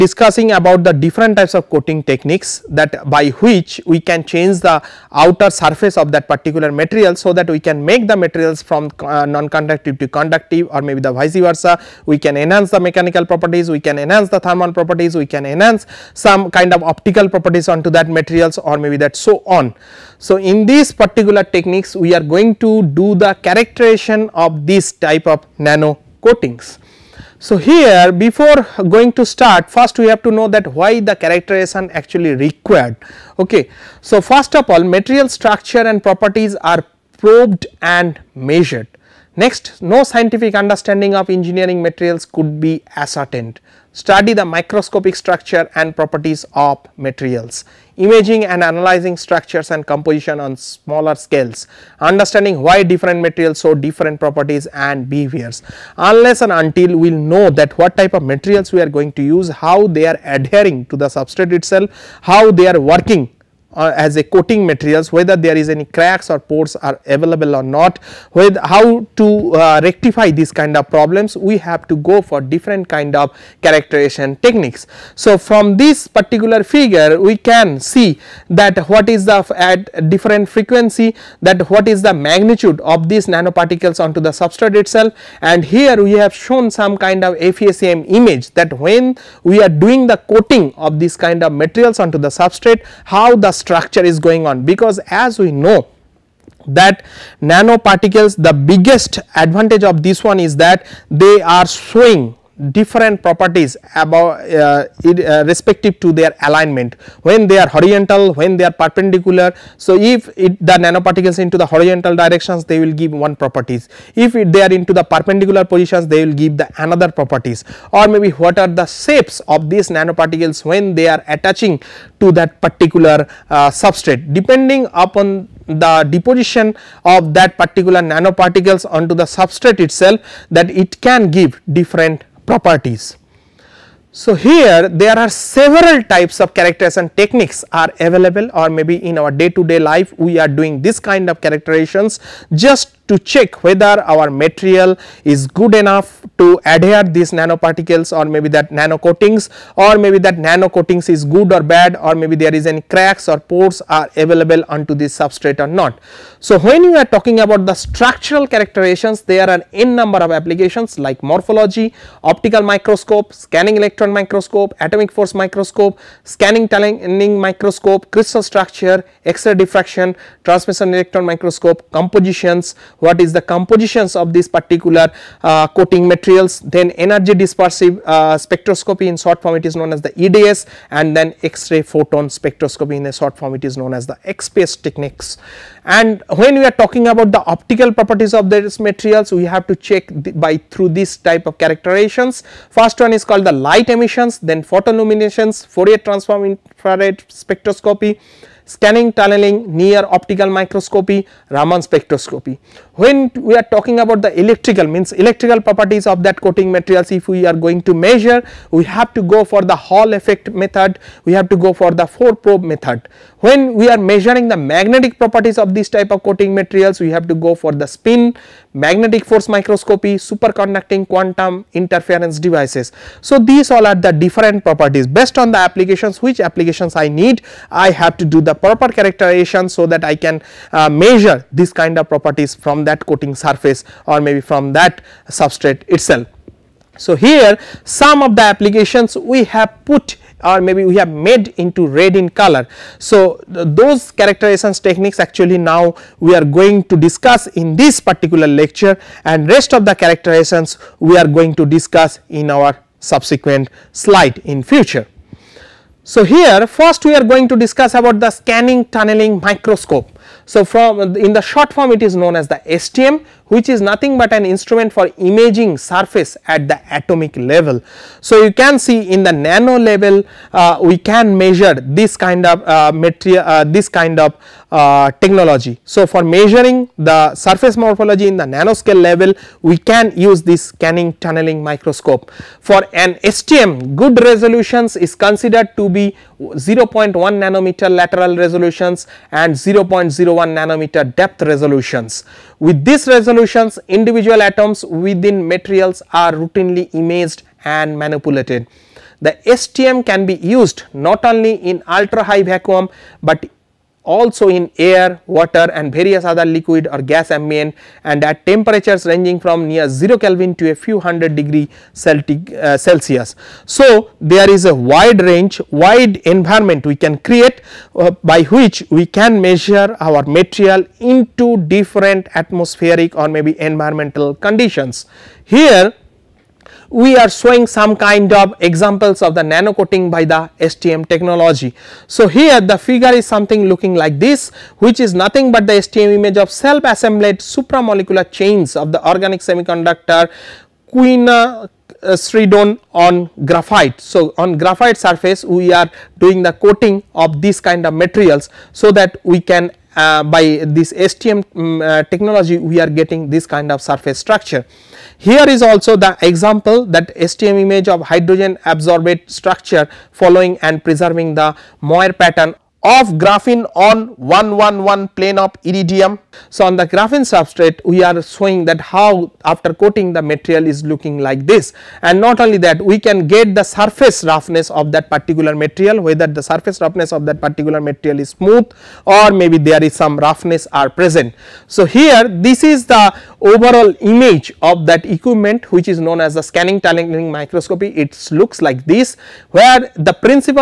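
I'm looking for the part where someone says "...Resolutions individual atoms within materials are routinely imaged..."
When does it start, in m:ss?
4:53.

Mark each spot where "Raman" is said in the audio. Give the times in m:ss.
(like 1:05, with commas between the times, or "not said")
3:21.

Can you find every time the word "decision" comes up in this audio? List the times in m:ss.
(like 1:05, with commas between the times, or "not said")
not said.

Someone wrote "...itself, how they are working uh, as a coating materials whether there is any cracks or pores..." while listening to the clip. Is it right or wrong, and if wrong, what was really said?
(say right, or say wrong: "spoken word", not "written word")
right.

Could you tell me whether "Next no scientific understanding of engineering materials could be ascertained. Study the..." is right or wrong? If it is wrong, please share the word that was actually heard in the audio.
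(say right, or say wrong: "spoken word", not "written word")
right.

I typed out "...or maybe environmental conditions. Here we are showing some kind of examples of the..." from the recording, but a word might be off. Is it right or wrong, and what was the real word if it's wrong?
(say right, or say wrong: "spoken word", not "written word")
right.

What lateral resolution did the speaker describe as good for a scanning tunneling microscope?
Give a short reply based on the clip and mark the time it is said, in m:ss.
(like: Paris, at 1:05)
0.1 nanometer, at 4:46.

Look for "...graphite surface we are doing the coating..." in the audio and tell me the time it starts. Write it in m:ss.
5:44.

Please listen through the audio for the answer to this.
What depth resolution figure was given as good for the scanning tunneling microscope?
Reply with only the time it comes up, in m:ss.
4:49.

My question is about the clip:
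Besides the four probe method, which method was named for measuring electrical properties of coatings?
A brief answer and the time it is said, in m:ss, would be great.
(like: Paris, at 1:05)
Hall effect method, at 3:29.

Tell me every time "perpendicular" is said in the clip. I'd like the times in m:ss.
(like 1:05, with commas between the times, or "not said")
1:48, 1:55.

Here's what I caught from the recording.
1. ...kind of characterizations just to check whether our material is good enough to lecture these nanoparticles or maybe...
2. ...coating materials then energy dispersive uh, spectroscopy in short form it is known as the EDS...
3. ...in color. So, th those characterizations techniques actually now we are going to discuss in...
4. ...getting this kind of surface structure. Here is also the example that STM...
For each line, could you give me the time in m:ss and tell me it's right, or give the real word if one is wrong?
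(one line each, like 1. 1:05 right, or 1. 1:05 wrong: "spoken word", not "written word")
1. 2:20 wrong: "adhere", not "lecture"
2. 2:55 right
3. 4:02 right
4. 5:52 right.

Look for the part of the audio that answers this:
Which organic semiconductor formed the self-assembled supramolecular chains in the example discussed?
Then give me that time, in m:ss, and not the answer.
5:40.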